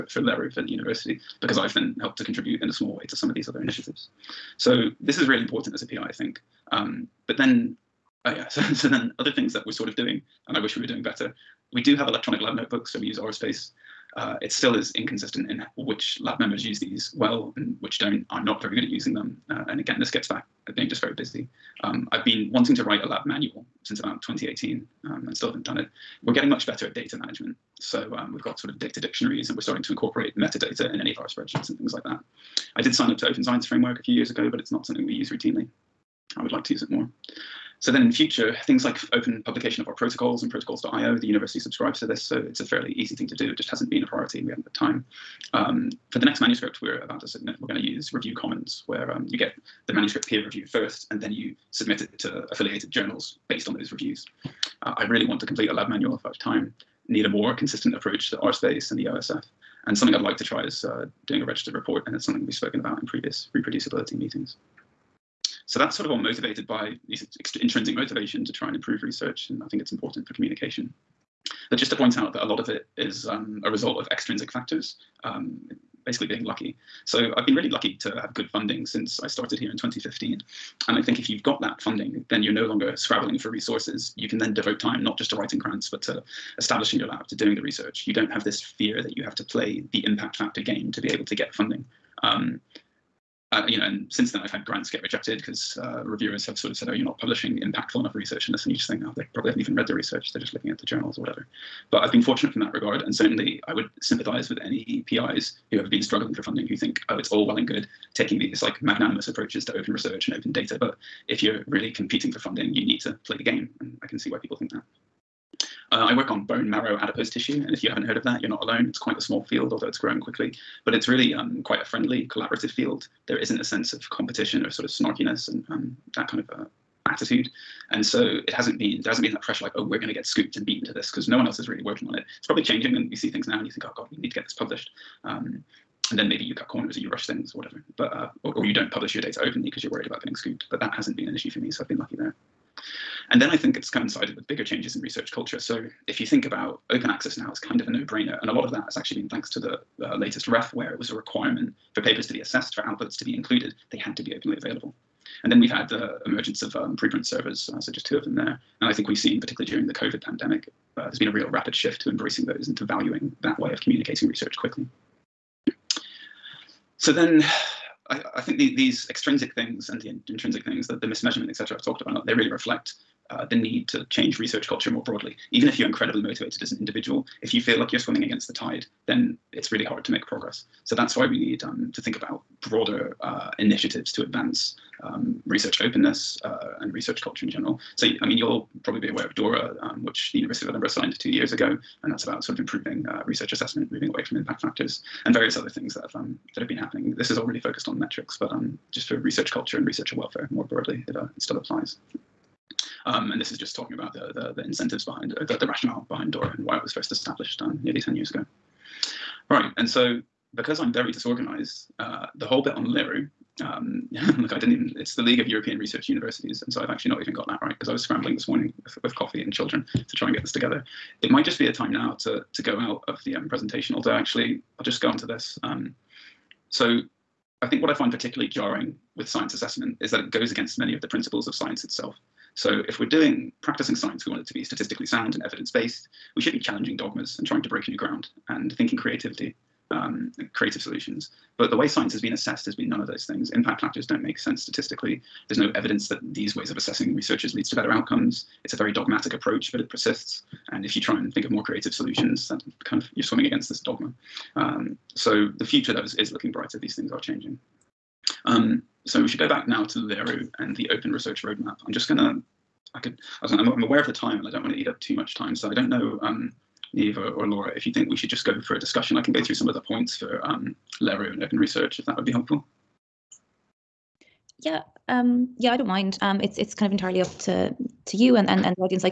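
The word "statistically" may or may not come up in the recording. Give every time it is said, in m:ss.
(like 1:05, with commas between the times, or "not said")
3:54, 4:04.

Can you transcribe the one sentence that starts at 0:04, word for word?
So this is really important as a PI, I think.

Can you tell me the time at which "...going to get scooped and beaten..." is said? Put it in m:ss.
2:09.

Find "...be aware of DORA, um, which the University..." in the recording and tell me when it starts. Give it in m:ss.
3:08.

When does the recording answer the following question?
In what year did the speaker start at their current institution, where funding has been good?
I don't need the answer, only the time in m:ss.
1:19.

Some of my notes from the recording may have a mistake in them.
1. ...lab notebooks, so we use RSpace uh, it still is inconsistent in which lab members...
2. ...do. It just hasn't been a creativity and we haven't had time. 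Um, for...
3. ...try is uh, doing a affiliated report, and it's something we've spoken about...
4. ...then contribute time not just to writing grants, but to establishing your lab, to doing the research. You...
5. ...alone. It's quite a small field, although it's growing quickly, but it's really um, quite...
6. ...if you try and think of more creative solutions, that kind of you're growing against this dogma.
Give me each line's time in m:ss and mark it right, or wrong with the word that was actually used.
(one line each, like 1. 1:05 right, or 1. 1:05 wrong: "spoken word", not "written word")
1. 0:12 right
2. 0:43 wrong: "priority", not "creativity"
3. 1:00 wrong: "registered", not "affiliated"
4. 1:24 wrong: "devote", not "contribute"
5. 1:58 right
6. 4:10 wrong: "swimming", not "growing".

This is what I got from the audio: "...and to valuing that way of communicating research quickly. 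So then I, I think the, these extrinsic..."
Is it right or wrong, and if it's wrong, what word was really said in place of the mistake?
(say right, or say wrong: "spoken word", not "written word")
right.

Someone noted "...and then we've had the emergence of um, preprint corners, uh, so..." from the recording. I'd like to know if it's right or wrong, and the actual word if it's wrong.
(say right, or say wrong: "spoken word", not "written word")
wrong: "servers", not "corners".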